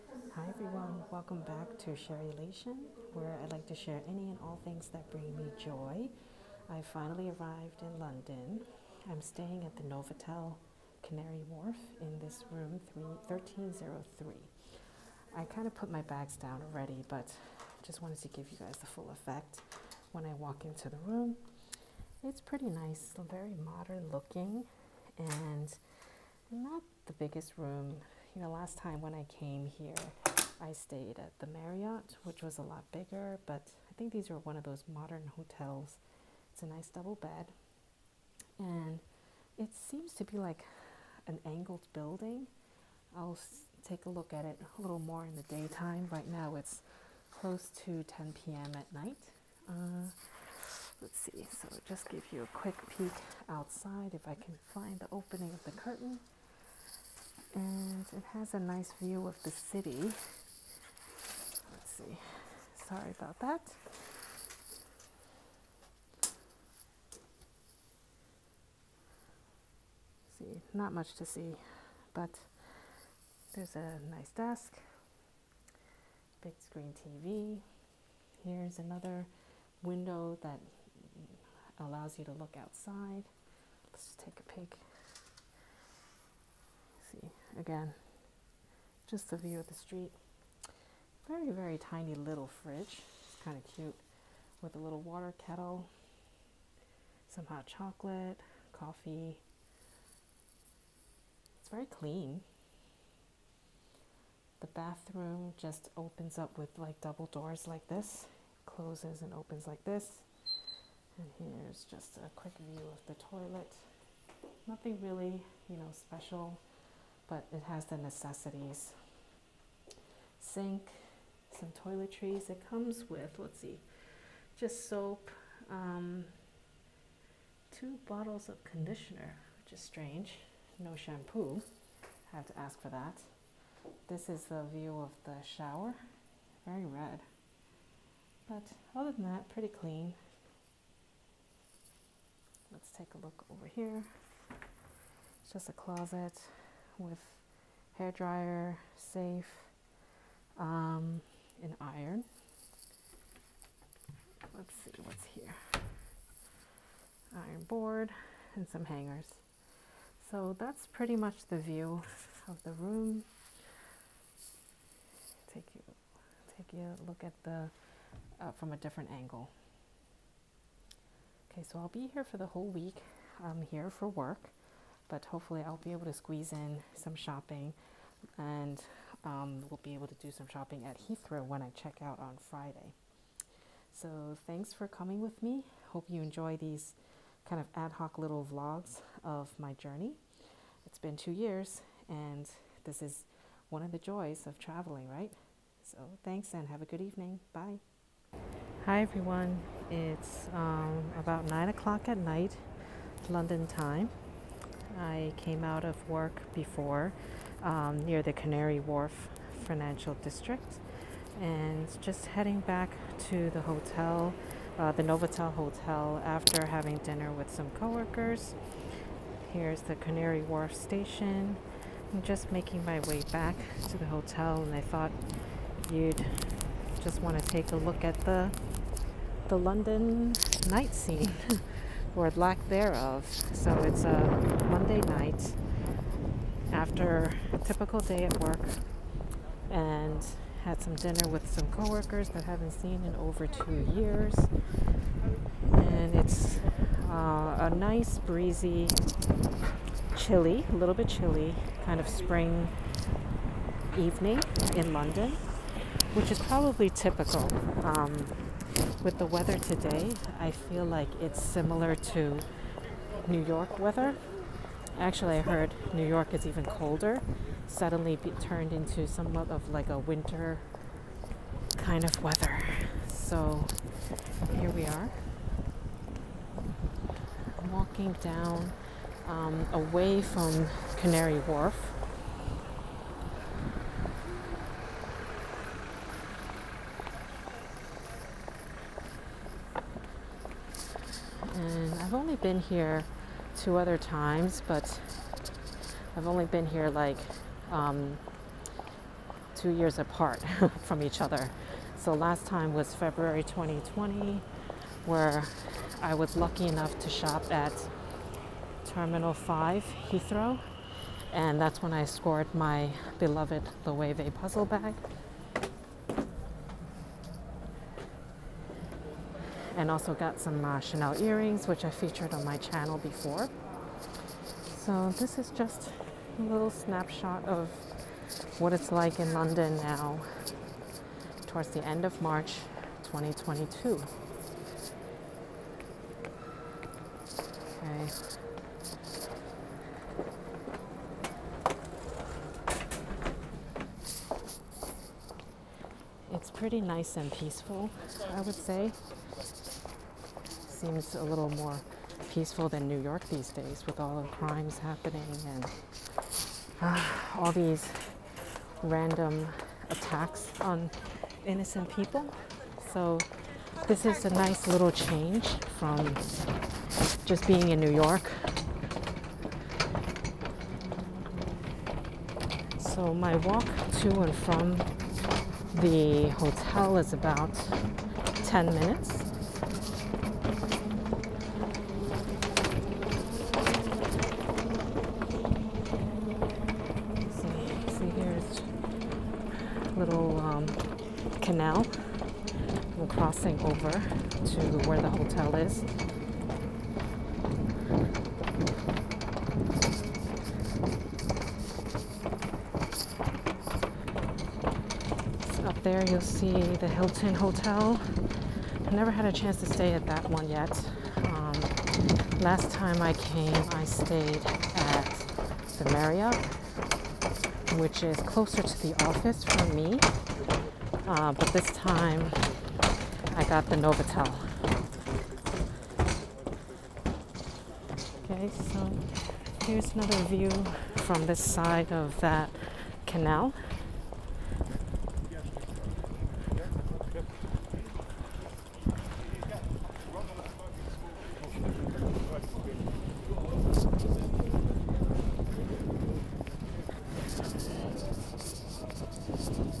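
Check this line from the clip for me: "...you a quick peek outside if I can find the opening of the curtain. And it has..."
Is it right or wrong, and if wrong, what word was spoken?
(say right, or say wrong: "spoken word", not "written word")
right.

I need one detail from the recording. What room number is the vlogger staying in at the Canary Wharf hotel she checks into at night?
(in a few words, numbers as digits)
1303.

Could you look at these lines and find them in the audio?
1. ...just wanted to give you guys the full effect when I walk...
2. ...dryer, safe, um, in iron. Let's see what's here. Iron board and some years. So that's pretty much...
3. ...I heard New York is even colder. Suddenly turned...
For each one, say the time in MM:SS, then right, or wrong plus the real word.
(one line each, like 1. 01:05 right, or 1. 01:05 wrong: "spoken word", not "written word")
1. 00:17 right
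2. 02:28 wrong: "hangers", not "years"
3. 04:25 right.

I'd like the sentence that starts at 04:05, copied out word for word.
And it's uh, a nice, breezy, chilly, a little bit chilly, kind of spring evening in London, which is probably typical.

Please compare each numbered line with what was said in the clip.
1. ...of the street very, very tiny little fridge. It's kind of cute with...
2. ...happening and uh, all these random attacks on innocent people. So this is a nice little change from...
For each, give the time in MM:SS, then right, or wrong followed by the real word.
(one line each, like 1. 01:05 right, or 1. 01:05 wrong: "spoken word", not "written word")
1. 01:29 right
2. 05:54 right.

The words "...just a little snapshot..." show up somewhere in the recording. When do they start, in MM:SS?
05:25.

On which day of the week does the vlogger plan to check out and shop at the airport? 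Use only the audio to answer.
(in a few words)
Friday.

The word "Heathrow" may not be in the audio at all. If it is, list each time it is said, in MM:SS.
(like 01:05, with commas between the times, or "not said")
03:00, 05:10.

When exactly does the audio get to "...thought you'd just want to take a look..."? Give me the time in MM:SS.
03:44.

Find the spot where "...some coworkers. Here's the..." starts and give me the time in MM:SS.
03:37.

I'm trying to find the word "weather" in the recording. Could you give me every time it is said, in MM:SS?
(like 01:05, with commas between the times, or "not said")
04:19, 04:23, 04:32.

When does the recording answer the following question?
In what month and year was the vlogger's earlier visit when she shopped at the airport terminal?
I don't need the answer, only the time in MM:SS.
05:02.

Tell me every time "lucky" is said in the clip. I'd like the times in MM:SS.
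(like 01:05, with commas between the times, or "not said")
05:06.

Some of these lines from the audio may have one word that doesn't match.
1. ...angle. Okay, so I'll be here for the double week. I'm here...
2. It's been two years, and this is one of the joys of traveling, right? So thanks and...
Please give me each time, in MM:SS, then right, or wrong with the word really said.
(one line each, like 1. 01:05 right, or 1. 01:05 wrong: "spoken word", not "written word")
1. 02:49 wrong: "whole", not "double"
2. 03:10 right.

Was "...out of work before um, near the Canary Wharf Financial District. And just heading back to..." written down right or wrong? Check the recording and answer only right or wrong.
right.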